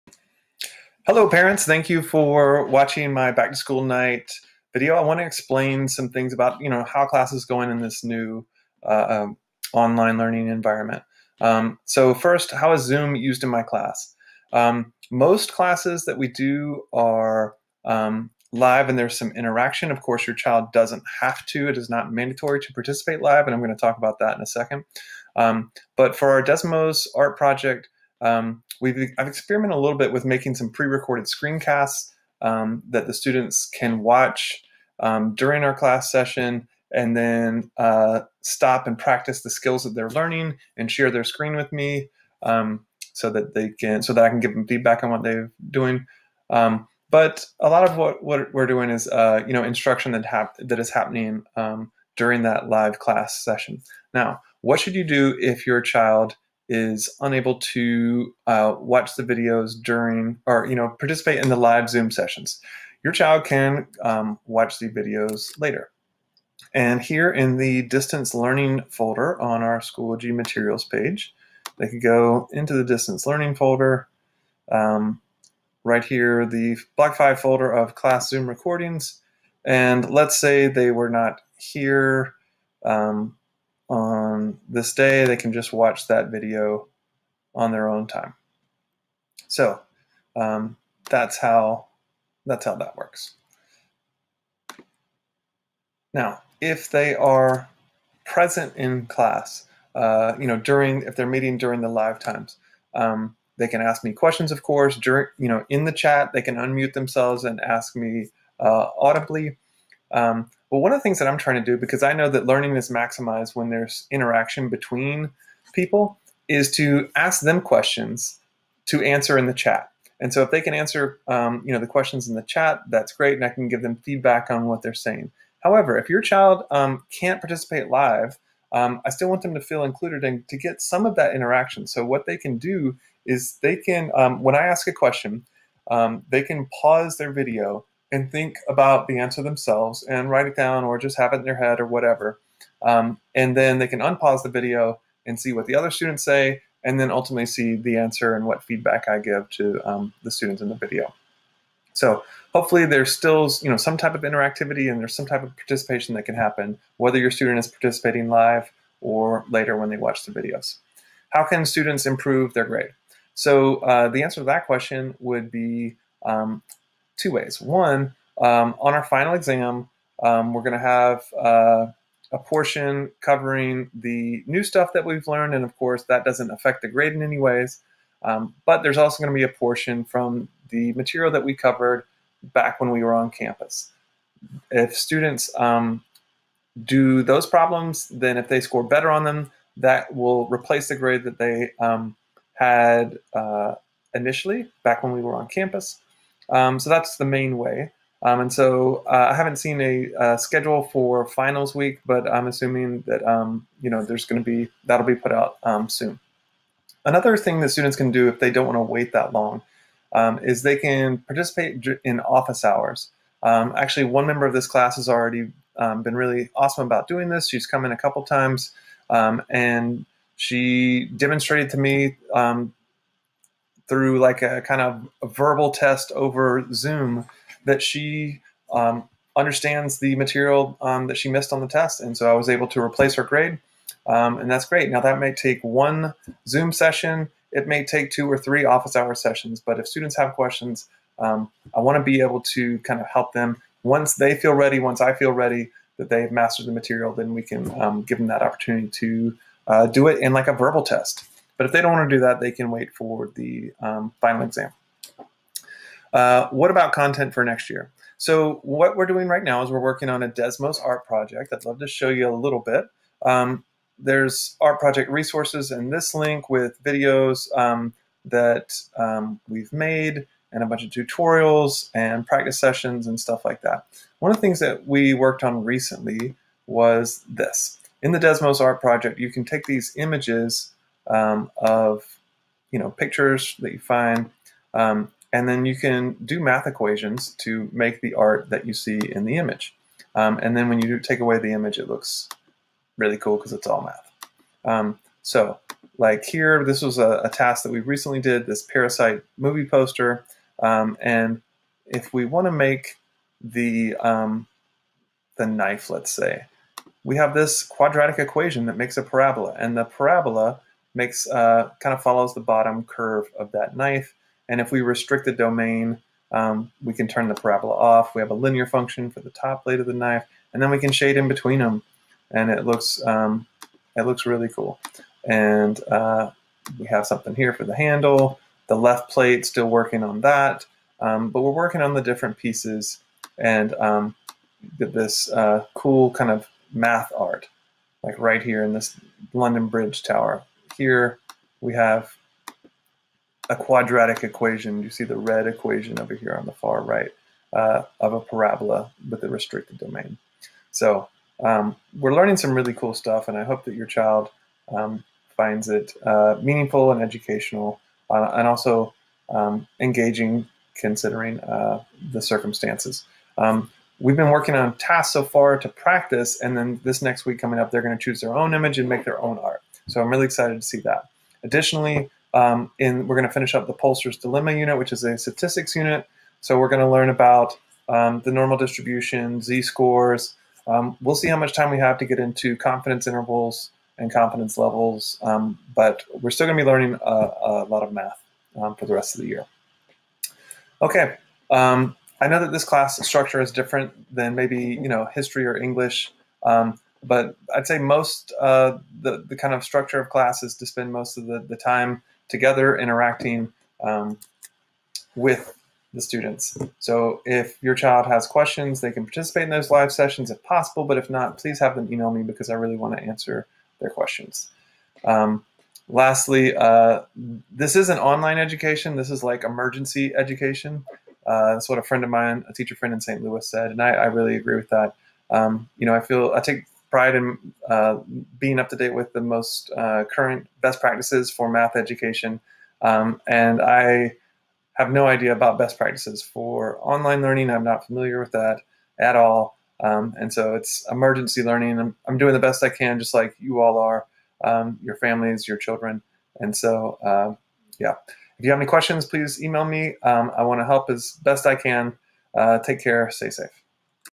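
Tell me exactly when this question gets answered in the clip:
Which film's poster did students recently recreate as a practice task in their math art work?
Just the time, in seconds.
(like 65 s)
298 s.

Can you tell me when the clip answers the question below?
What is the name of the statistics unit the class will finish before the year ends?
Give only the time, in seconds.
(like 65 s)
373 s.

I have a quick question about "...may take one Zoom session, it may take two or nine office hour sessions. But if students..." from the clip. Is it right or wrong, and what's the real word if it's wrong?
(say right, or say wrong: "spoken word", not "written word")
wrong: "three", not "nine".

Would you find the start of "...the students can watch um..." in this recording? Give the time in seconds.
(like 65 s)
33 s.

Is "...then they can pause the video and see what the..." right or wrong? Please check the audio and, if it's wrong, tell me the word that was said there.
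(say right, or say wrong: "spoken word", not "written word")
wrong: "unpause", not "pause".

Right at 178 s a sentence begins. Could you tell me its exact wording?
Um, but there's also going to be a portion from the material that we covered back when we were on campus.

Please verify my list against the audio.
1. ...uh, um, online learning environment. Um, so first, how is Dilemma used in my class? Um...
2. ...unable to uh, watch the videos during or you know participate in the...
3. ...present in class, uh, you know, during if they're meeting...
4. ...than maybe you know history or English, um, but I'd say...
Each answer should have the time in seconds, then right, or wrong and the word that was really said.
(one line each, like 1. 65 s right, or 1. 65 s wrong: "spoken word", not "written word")
1. 8 s wrong: "Zoom", not "Dilemma"
2. 57 s right
3. 98 s right
4. 394 s right.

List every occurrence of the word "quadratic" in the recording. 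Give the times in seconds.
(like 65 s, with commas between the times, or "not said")
307 s, 343 s.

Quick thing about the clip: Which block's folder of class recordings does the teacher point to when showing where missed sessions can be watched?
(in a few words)
Block 5.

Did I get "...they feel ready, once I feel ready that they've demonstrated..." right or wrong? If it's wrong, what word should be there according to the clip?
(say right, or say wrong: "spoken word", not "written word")
wrong: "mastered", not "demonstrated".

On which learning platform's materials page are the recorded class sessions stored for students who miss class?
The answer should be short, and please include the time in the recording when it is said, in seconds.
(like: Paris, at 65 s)
Schoology, at 69 s.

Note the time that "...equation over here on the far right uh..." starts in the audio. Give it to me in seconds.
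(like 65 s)
345 s.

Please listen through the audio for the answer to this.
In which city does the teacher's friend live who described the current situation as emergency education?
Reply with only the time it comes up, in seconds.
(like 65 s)
423 s.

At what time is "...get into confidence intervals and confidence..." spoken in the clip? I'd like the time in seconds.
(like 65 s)
382 s.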